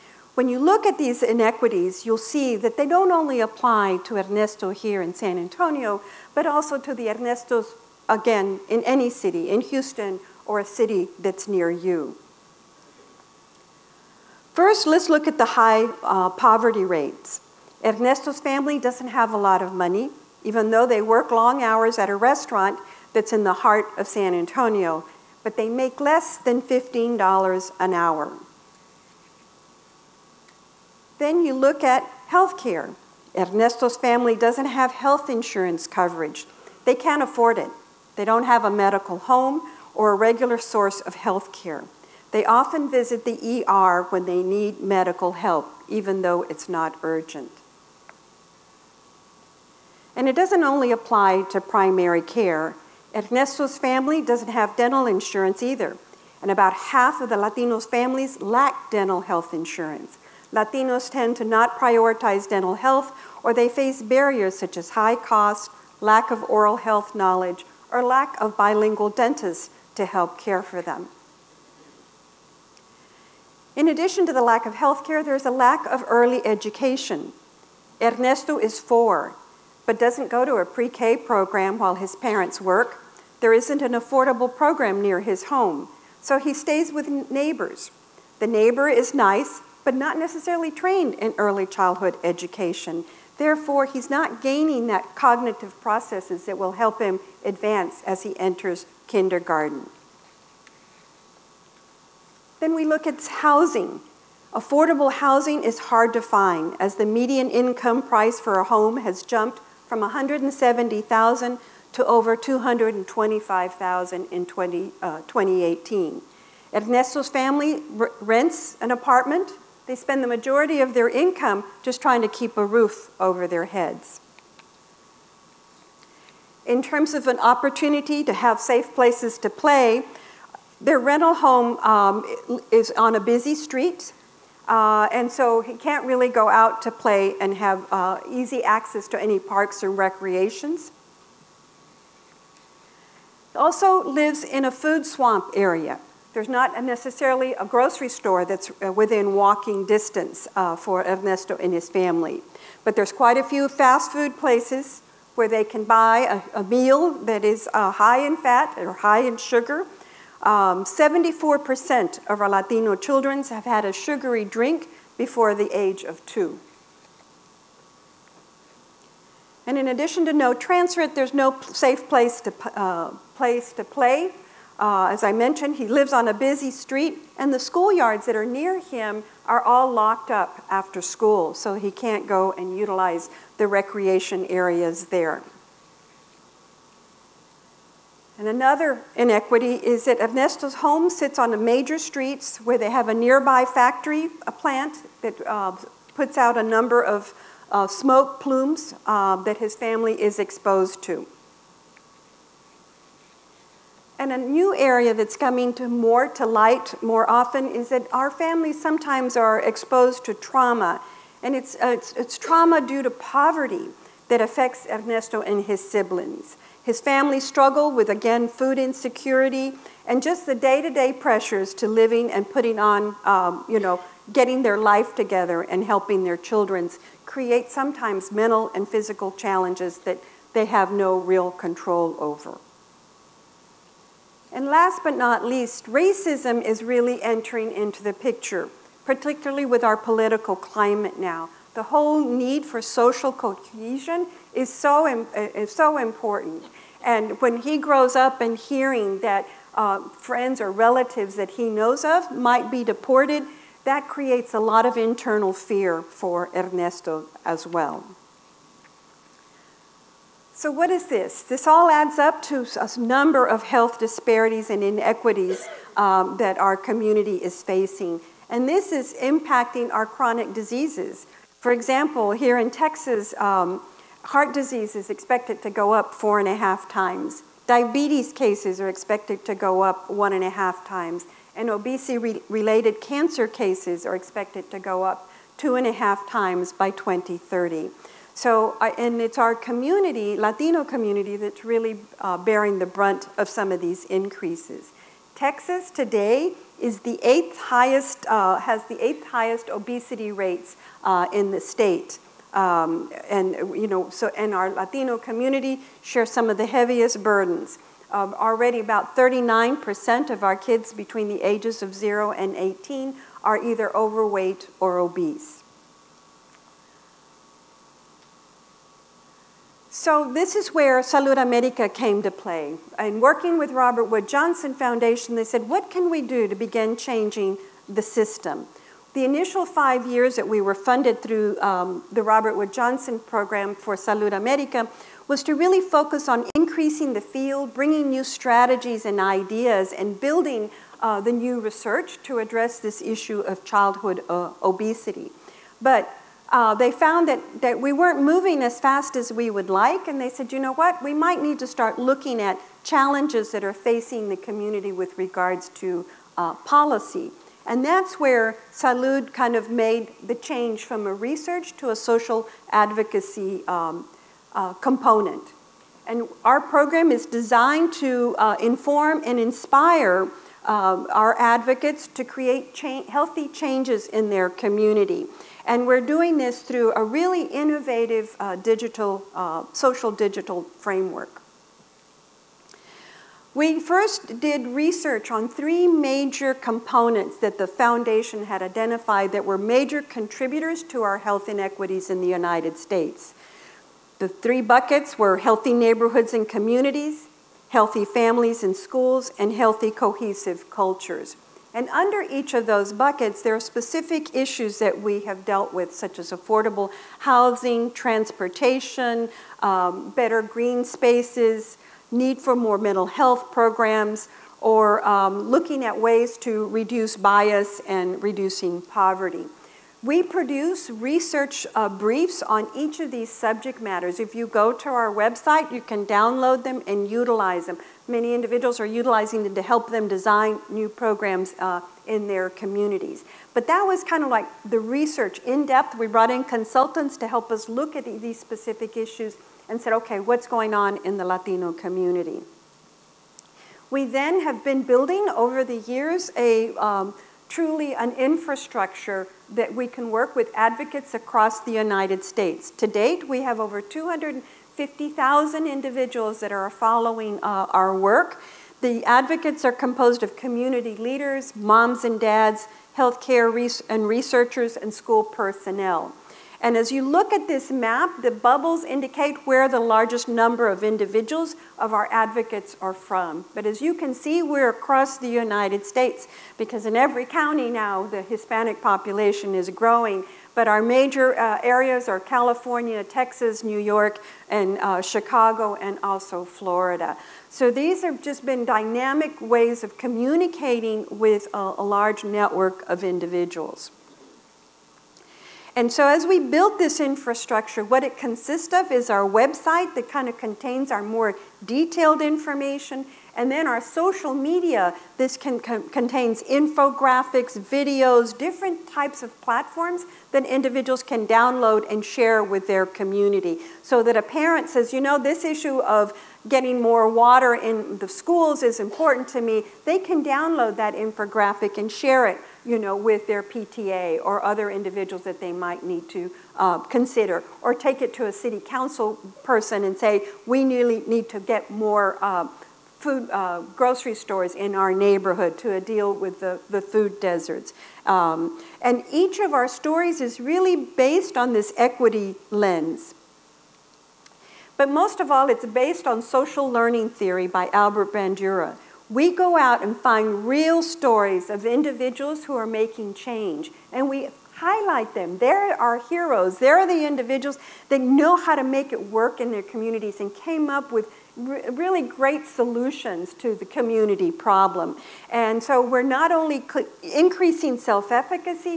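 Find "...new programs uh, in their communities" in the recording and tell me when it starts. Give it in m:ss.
7:10.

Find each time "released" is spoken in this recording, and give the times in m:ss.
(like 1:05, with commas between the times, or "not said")
not said.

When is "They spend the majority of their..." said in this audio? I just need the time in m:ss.
1:59.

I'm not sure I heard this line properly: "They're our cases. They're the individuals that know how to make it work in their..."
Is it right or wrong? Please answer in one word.
wrong.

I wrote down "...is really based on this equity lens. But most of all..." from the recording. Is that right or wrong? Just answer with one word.
right.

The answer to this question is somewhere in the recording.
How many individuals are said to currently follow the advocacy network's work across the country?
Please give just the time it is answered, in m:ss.
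7:33.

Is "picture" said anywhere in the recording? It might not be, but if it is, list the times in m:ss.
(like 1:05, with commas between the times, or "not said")
3:58.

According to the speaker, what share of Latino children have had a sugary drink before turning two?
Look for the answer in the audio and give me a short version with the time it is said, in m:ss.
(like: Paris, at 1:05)
74%, at 2:40.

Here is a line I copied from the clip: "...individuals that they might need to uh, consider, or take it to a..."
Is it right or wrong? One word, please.
right.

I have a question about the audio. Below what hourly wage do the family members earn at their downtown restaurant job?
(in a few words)
$15.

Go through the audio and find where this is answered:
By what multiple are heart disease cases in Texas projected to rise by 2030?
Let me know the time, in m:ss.
4:36.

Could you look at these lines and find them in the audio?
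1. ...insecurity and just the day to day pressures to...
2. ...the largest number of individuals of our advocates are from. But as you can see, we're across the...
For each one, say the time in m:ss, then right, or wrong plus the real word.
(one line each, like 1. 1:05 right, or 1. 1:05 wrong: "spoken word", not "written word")
1. 3:38 right
2. 7:49 right.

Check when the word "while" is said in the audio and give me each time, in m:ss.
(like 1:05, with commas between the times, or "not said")
1:21.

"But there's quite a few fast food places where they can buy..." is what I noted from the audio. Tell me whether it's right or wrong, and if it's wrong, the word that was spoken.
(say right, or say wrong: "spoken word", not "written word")
right.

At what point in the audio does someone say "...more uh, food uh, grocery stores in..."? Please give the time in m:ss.
8:51.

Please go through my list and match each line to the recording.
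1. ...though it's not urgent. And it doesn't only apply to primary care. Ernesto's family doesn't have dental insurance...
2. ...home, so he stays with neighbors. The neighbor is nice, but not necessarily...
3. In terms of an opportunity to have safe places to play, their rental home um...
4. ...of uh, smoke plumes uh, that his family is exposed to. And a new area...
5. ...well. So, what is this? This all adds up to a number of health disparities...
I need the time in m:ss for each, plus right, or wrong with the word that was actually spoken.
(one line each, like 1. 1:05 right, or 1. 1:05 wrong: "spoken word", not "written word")
1. 0:46 right
2. 1:25 right
3. 2:06 right
4. 3:17 right
5. 4:17 right.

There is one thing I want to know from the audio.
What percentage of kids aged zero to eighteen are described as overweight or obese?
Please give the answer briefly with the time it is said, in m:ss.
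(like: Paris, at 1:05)
39%, at 5:09.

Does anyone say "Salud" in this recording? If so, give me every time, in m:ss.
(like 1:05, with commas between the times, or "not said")
5:21, 5:33, 5:58.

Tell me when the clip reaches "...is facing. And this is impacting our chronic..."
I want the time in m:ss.
4:27.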